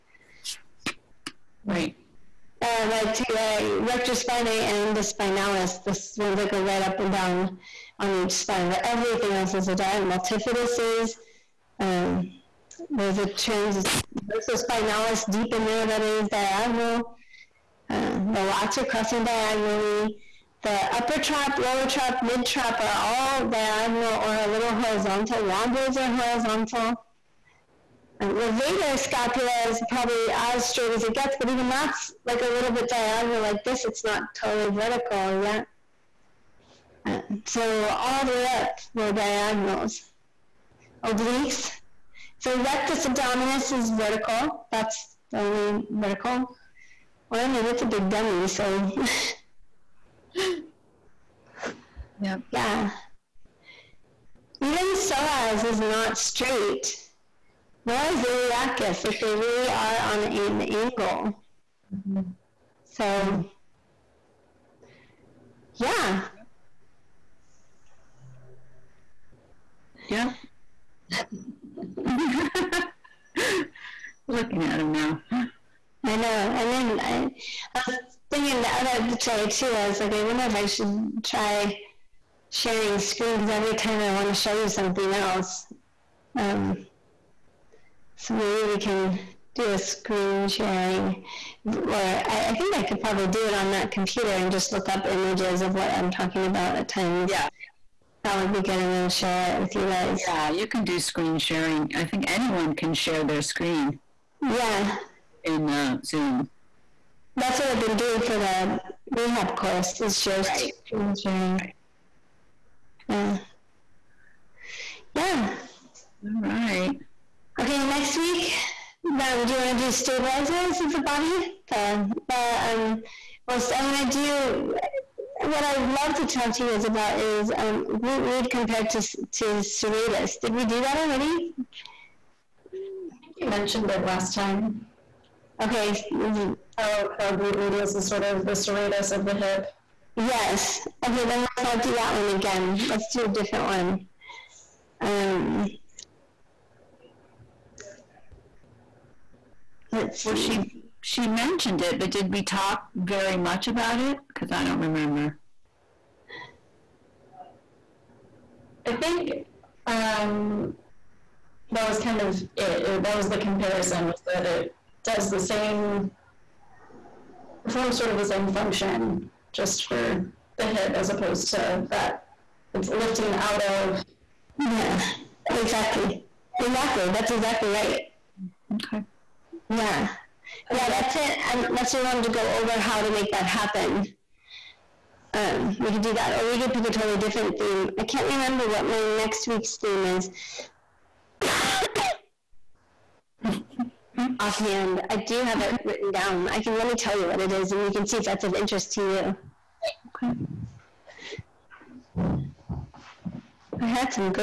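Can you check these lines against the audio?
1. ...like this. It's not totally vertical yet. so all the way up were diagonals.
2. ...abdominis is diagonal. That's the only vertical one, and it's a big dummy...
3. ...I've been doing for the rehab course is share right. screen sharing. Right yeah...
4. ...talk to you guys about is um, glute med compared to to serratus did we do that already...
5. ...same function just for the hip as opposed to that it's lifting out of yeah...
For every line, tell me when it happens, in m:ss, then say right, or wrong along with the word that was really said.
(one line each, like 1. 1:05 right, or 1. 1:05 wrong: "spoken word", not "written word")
1. 0:33 right
2. 0:43 wrong: "vertical", not "diagonal"
3. 1:47 right
4. 2:06 right
5. 2:48 right.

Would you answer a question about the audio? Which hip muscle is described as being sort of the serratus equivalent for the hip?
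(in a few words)
Glute medius.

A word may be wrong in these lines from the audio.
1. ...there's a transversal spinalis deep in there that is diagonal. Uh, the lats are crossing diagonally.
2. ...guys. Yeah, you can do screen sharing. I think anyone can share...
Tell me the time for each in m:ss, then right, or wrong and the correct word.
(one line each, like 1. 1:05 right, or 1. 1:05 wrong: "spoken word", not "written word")
1. 0:12 right
2. 1:39 right.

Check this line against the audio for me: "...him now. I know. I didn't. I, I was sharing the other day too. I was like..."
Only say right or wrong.
wrong.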